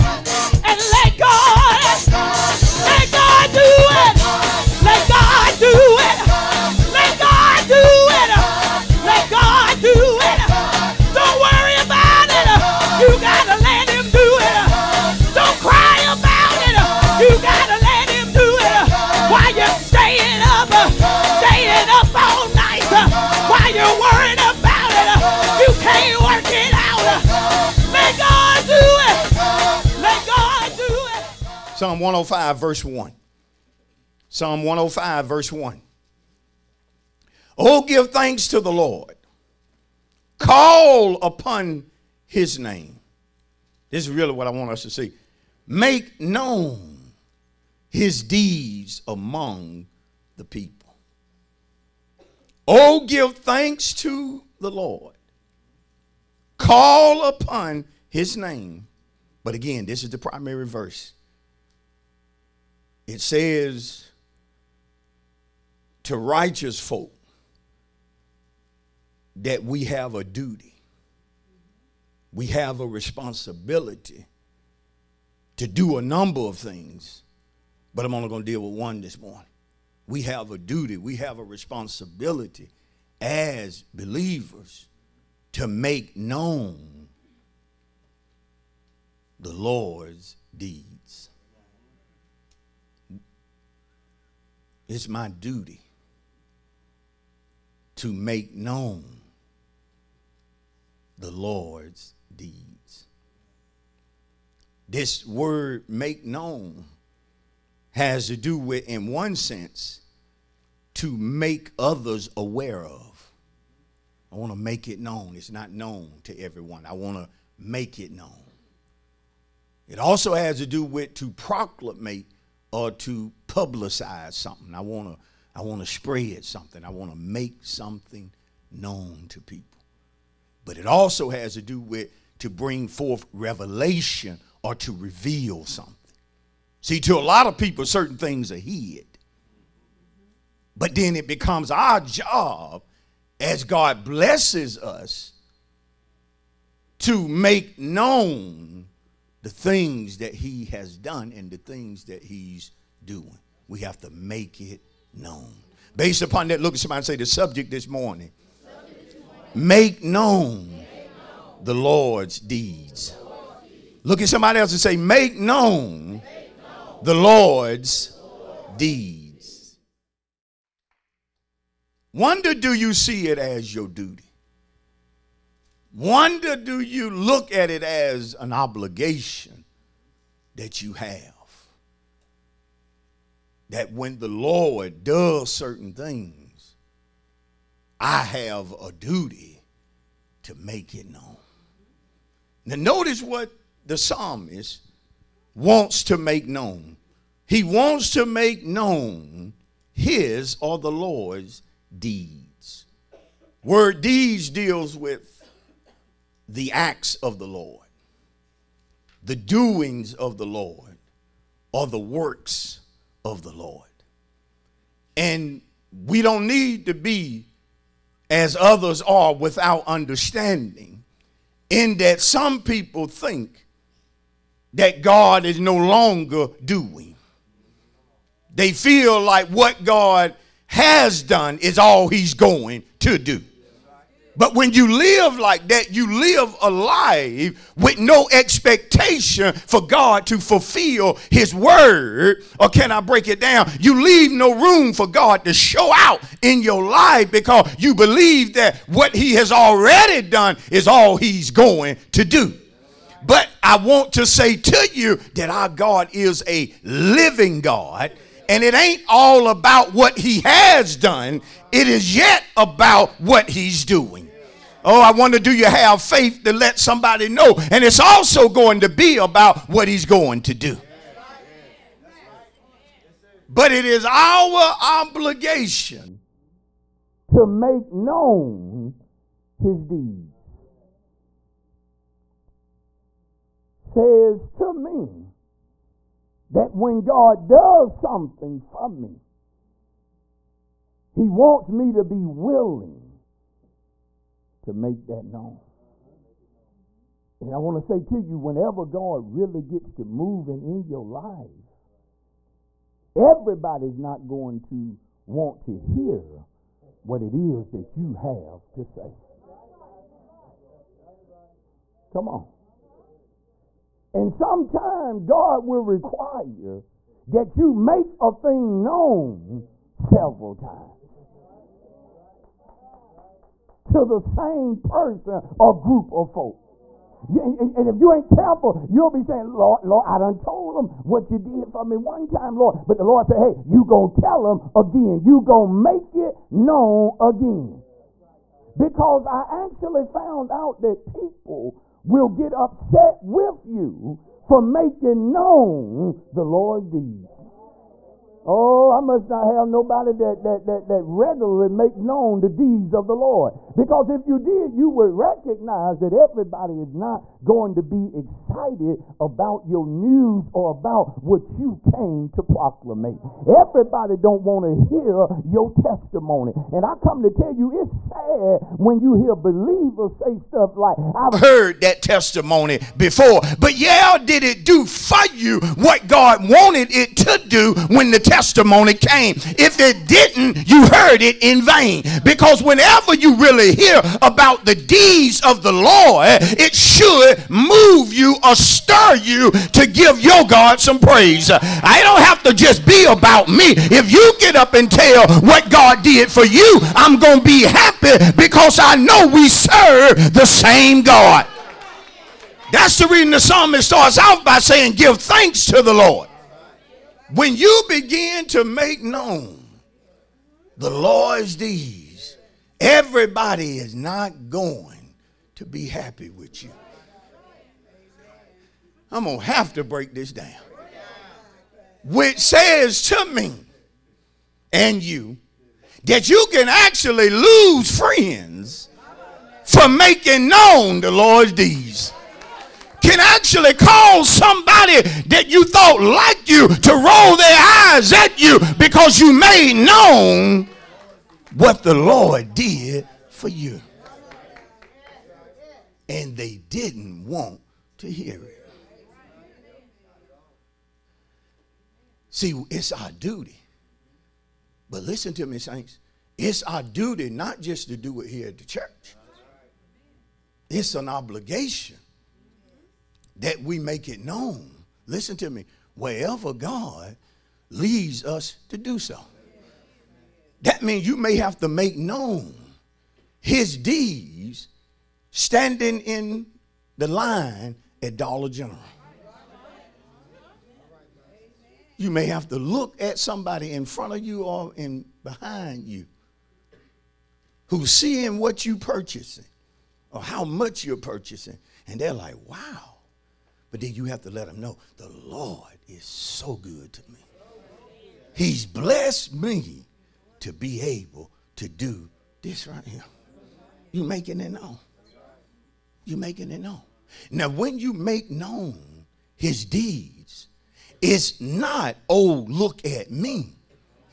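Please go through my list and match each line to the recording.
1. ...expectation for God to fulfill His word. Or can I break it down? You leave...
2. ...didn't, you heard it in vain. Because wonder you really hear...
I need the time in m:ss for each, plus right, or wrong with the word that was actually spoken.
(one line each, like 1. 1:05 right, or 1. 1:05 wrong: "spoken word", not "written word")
1. 3:58 right
2. 6:20 wrong: "whenever", not "wonder".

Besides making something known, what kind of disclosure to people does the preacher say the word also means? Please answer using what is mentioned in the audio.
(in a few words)
revelation.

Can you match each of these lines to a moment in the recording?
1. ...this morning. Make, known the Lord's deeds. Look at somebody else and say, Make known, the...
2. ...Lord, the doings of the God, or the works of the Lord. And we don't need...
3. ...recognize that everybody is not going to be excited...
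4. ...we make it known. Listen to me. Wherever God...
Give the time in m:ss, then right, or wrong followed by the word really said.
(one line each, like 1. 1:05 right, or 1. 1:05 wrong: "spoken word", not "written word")
1. 2:37 right
2. 3:27 wrong: "Lord", not "God"
3. 5:55 right
4. 7:43 right.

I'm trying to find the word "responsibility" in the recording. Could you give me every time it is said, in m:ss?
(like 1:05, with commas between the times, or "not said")
1:12, 1:21.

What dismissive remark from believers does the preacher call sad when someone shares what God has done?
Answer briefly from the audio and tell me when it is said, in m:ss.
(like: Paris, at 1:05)
I've heard that testimony before, at 6:11.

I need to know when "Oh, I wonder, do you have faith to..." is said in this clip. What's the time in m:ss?
4:24.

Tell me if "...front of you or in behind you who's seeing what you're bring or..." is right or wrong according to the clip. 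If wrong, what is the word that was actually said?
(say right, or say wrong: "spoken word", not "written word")
wrong: "purchasing", not "bring".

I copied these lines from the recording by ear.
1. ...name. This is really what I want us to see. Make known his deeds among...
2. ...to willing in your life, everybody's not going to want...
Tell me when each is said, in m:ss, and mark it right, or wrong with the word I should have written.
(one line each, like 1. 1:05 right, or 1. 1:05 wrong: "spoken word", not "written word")
1. 0:42 right
2. 4:59 wrong: "moving", not "willing".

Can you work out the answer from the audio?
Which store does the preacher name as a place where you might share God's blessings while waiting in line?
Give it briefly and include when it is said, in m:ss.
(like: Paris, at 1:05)
Dollar General, at 7:58.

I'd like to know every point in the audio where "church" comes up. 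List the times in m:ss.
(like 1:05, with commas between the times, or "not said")
7:38.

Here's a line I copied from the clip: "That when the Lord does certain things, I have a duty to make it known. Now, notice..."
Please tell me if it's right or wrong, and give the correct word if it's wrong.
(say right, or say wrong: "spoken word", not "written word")
right.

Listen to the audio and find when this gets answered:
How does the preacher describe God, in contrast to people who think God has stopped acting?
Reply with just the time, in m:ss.
4:16.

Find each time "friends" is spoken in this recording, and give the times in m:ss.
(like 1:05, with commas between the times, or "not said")
7:07.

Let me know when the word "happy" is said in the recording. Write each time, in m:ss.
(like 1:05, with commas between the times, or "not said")
6:37, 6:55.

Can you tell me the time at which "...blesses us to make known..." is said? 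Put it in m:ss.
2:24.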